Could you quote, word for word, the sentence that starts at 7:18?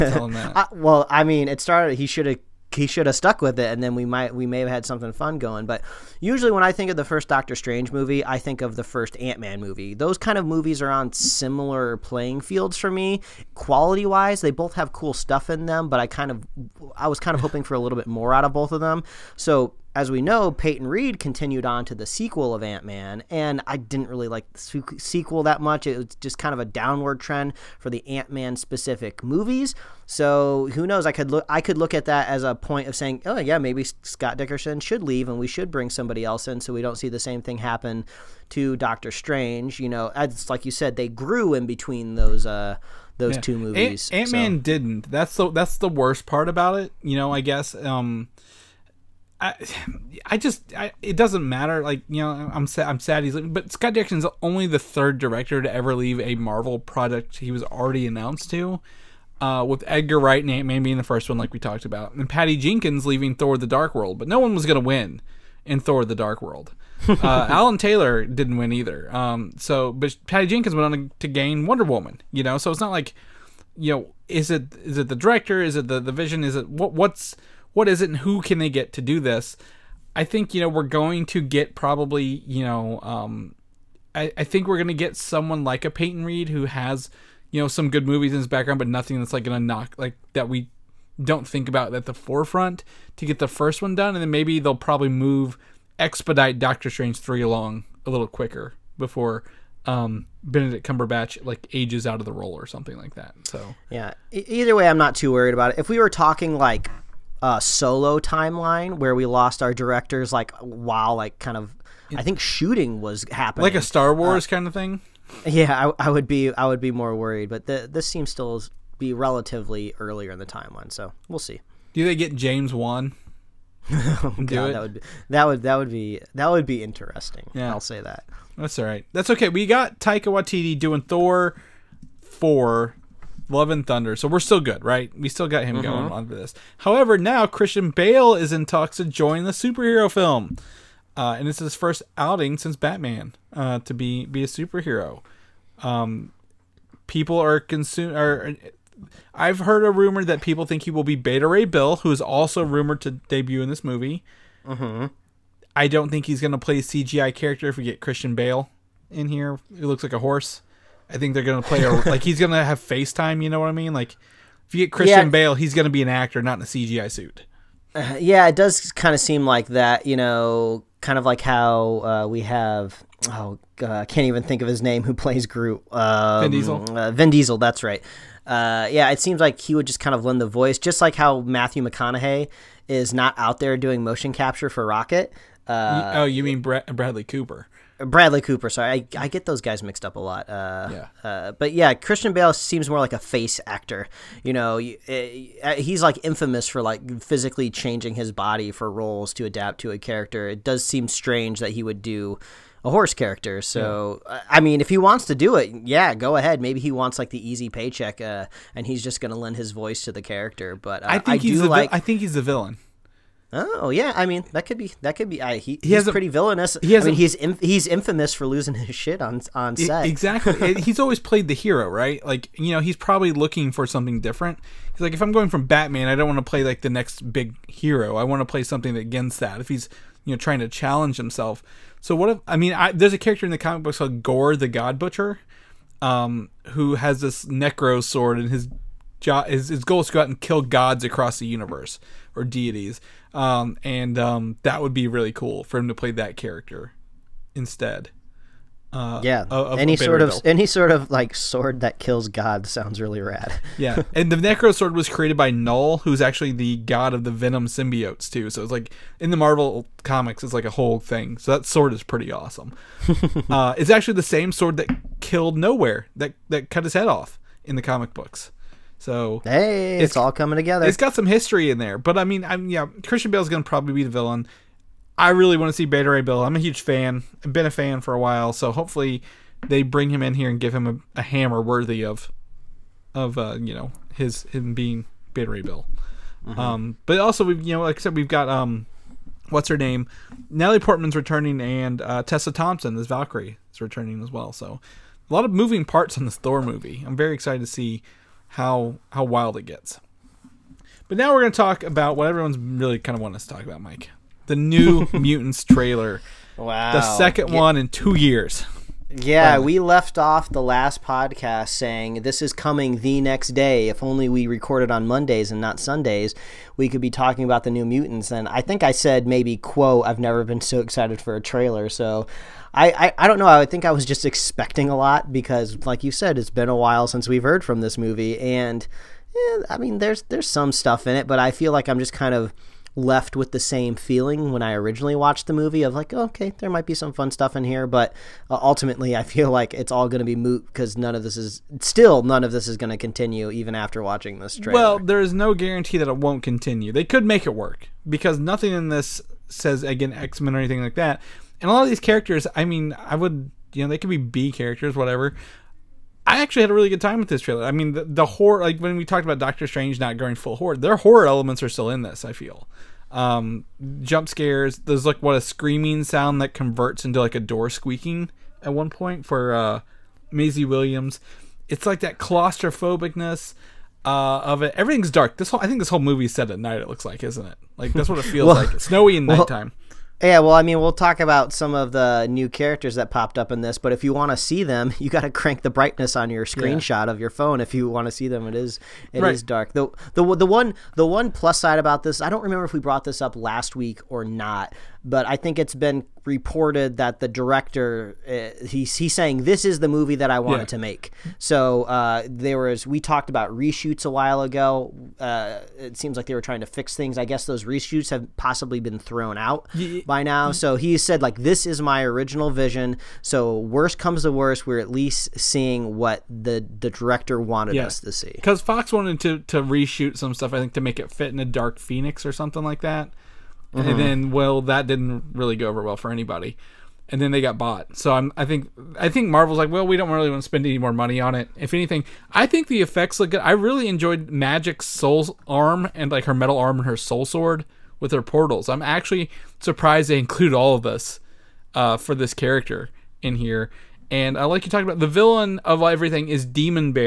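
I'm actually surprised they include all of this uh, for this character in here.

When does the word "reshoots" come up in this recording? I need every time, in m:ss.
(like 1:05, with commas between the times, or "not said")
6:43, 6:47, 6:59.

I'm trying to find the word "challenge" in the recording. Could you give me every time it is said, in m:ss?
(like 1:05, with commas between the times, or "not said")
3:50.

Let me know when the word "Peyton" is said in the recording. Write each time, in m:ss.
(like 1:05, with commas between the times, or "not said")
0:20, 1:25.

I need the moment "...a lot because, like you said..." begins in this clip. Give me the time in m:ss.
5:24.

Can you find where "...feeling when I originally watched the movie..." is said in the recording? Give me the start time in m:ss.
5:33.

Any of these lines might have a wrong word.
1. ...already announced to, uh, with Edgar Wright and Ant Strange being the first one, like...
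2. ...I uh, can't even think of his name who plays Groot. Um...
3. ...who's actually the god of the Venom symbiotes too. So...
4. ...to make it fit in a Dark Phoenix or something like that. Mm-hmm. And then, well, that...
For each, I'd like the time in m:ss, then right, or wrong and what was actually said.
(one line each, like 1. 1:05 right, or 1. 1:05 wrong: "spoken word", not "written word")
1. 0:57 wrong: "Man", not "Strange"
2. 2:53 right
3. 4:16 right
4. 7:00 right.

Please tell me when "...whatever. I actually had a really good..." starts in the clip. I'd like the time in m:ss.
5:54.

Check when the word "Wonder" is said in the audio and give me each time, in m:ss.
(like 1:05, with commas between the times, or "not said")
1:11.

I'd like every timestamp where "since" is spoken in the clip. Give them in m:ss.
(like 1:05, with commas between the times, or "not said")
2:22, 5:27.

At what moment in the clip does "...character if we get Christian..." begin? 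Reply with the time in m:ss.
2:37.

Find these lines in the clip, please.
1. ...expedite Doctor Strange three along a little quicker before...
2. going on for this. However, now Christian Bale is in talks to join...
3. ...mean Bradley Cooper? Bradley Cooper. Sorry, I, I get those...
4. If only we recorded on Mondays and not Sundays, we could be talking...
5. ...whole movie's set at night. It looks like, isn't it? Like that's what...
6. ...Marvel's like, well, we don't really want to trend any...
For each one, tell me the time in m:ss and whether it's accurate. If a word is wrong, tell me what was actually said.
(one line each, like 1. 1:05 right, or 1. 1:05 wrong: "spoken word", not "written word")
1. 1:35 right
2. 2:15 right
3. 3:06 right
4. 5:13 right
5. 6:15 right
6. 7:09 wrong: "spend", not "trend".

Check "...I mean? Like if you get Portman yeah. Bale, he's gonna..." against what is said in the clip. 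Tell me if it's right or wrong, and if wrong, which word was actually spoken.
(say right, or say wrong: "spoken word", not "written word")
wrong: "Christian", not "Portman".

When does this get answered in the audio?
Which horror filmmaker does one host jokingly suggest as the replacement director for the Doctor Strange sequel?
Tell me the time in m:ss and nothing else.
2:02.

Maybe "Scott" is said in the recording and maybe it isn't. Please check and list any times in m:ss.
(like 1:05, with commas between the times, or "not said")
0:33, 0:53.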